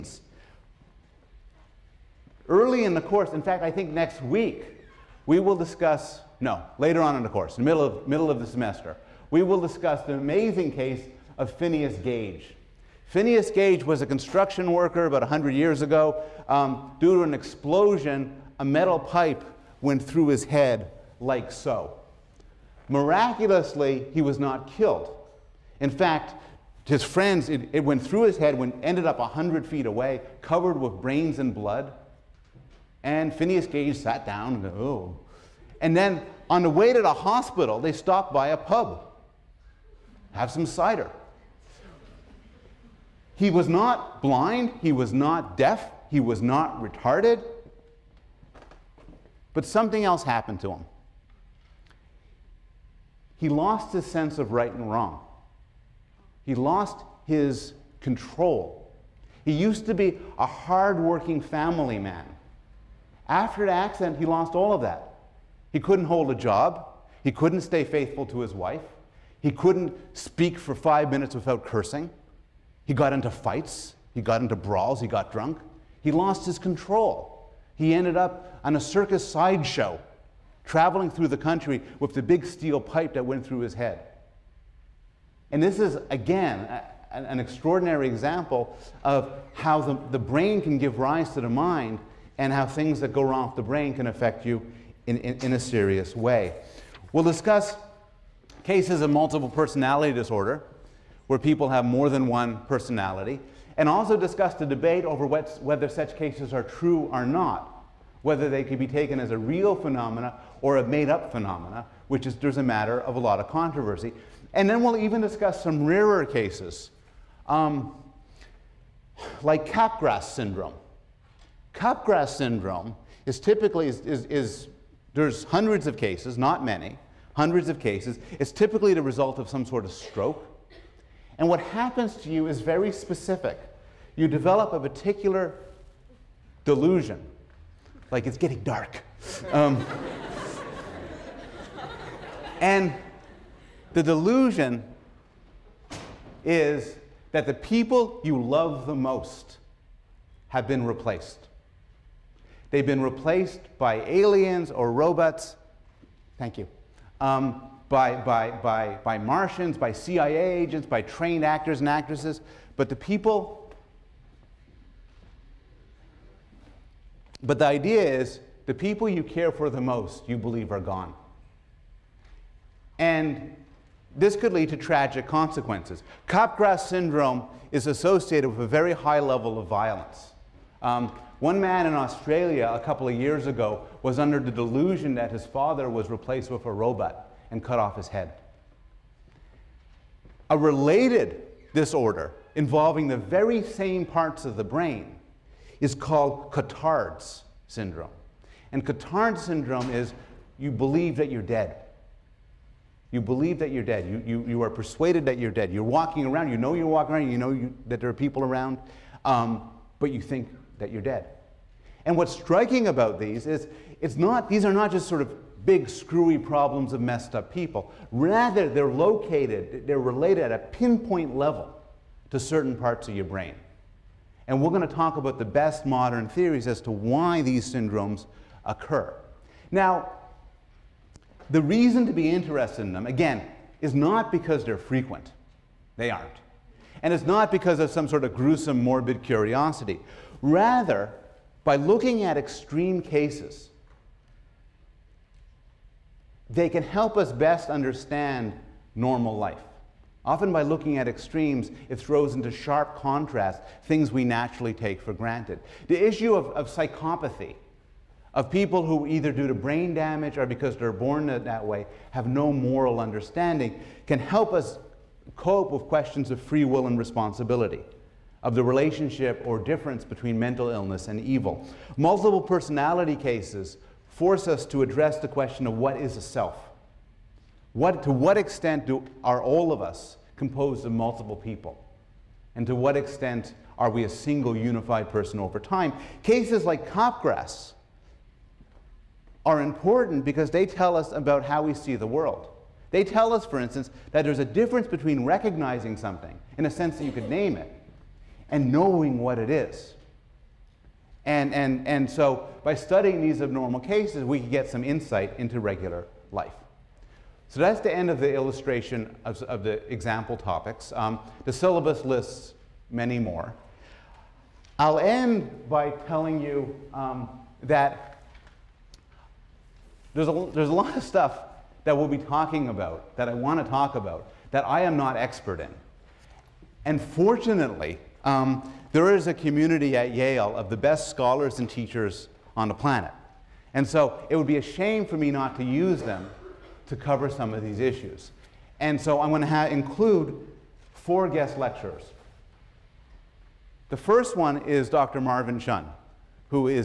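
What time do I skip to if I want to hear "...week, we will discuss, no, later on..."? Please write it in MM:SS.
00:04.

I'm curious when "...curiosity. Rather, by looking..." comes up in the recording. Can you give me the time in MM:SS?
03:59.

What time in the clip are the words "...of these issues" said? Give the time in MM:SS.
05:37.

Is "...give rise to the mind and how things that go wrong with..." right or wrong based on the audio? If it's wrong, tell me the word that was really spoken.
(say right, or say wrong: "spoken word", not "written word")
right.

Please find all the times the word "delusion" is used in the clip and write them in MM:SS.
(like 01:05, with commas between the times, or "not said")
02:16, 02:24, 03:04.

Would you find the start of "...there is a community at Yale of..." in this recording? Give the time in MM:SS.
05:28.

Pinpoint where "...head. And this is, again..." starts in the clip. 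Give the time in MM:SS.
01:23.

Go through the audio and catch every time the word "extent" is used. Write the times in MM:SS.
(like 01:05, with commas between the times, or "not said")
04:38, 04:42.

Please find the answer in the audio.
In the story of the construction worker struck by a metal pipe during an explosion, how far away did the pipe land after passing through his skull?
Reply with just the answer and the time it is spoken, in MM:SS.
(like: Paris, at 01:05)
100 feet, at 00:29.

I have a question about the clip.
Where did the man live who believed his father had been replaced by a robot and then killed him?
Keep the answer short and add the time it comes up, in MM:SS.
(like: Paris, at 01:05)
Australia, at 03:01.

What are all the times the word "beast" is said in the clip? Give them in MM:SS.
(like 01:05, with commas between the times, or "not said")
not said.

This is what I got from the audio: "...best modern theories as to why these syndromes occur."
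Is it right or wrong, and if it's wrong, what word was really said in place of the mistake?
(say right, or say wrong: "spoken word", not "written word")
right.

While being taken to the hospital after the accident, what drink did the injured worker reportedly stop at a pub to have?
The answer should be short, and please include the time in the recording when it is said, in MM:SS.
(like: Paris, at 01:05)
cider, at 00:40.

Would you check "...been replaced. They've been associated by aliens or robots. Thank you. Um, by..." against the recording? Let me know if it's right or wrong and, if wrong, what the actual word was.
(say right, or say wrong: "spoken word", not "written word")
wrong: "replaced", not "associated".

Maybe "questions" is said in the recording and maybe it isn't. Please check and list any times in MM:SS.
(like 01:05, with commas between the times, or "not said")
04:25, 04:35.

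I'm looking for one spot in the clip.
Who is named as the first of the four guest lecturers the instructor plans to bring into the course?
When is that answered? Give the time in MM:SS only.
05:44.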